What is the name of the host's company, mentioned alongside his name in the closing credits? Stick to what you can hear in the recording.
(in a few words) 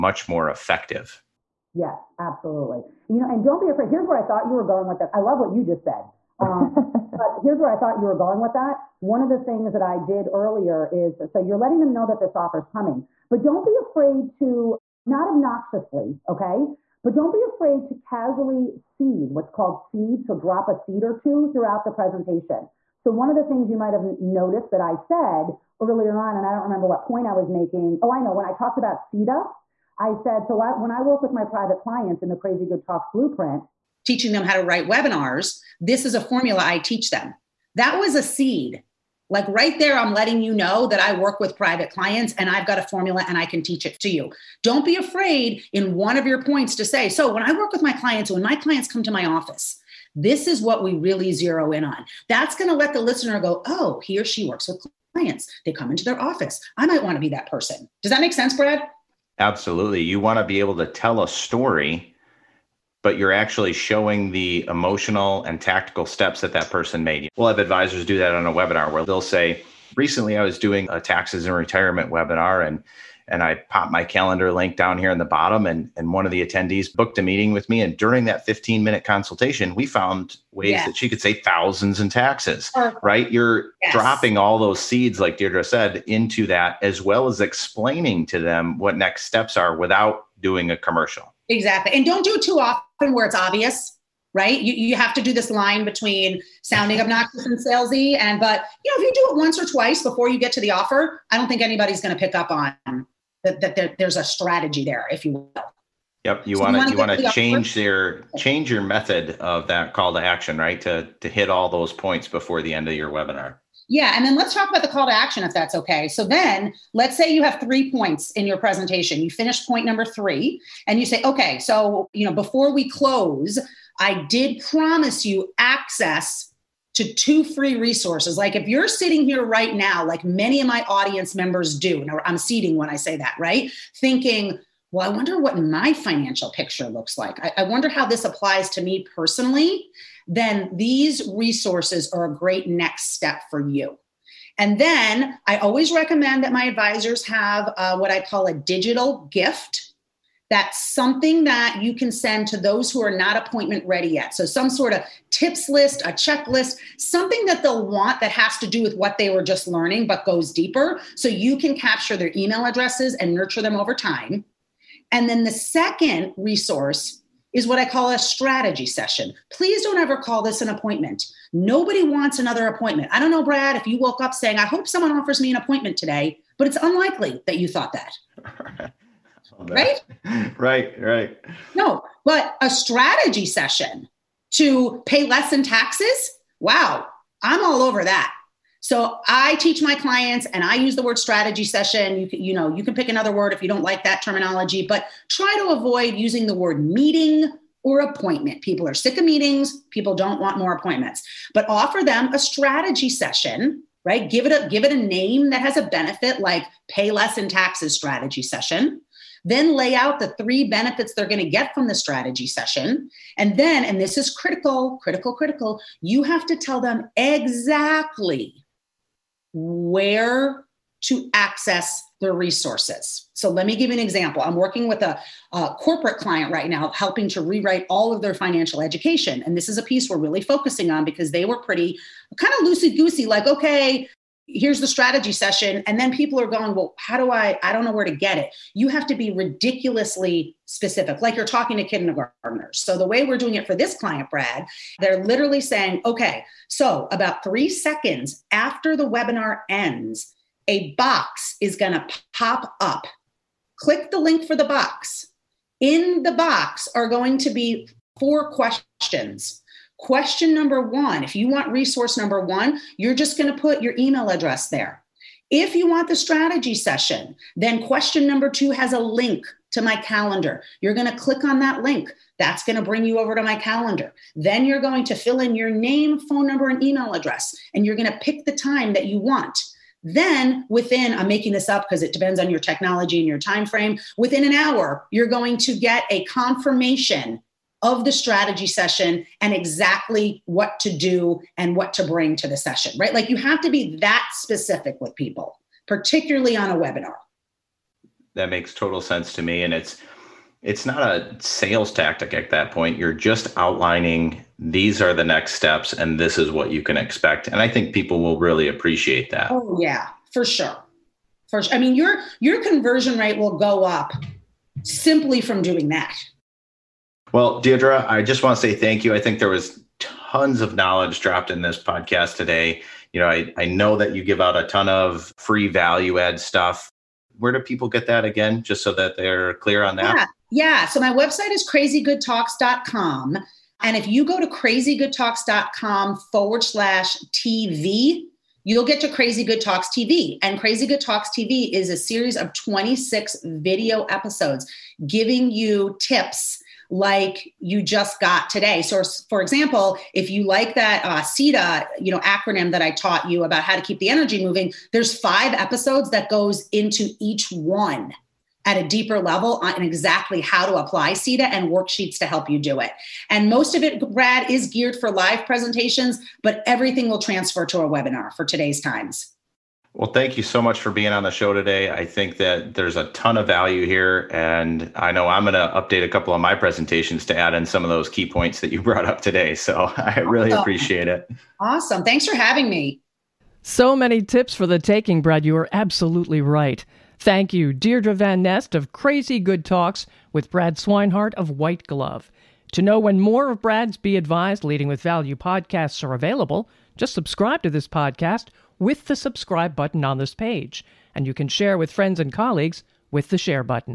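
White Glove.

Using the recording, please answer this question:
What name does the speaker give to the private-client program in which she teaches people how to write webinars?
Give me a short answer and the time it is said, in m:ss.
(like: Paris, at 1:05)
Crazy Good Talks blueprint, at 0:32.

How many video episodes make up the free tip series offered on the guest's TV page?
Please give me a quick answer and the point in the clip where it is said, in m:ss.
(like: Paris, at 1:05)
26, at 5:42.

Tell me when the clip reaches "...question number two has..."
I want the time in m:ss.
4:27.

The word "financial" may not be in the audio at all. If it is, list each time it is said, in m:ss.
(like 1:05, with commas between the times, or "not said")
2:15, 3:48.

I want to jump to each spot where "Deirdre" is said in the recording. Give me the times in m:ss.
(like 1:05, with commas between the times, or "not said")
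1:25, 5:17, 6:27.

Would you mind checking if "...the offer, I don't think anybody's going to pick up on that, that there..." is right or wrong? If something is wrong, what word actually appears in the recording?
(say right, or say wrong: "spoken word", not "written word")
right.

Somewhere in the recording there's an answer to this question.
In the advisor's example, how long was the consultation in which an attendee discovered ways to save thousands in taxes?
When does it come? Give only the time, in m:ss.
1:18.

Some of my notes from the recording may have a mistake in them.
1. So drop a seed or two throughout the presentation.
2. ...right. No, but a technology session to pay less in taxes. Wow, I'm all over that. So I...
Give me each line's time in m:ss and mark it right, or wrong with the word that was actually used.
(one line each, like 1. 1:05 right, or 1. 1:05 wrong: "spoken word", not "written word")
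1. 0:20 right
2. 3:00 wrong: "strategy", not "technology".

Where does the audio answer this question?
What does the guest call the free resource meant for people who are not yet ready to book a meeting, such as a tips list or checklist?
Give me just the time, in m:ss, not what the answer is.
2:28.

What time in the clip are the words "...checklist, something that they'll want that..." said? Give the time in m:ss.
2:36.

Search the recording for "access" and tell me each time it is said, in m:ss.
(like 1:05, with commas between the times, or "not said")
2:05, 3:41.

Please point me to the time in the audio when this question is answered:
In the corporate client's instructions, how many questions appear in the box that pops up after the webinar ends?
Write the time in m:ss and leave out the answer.
4:18.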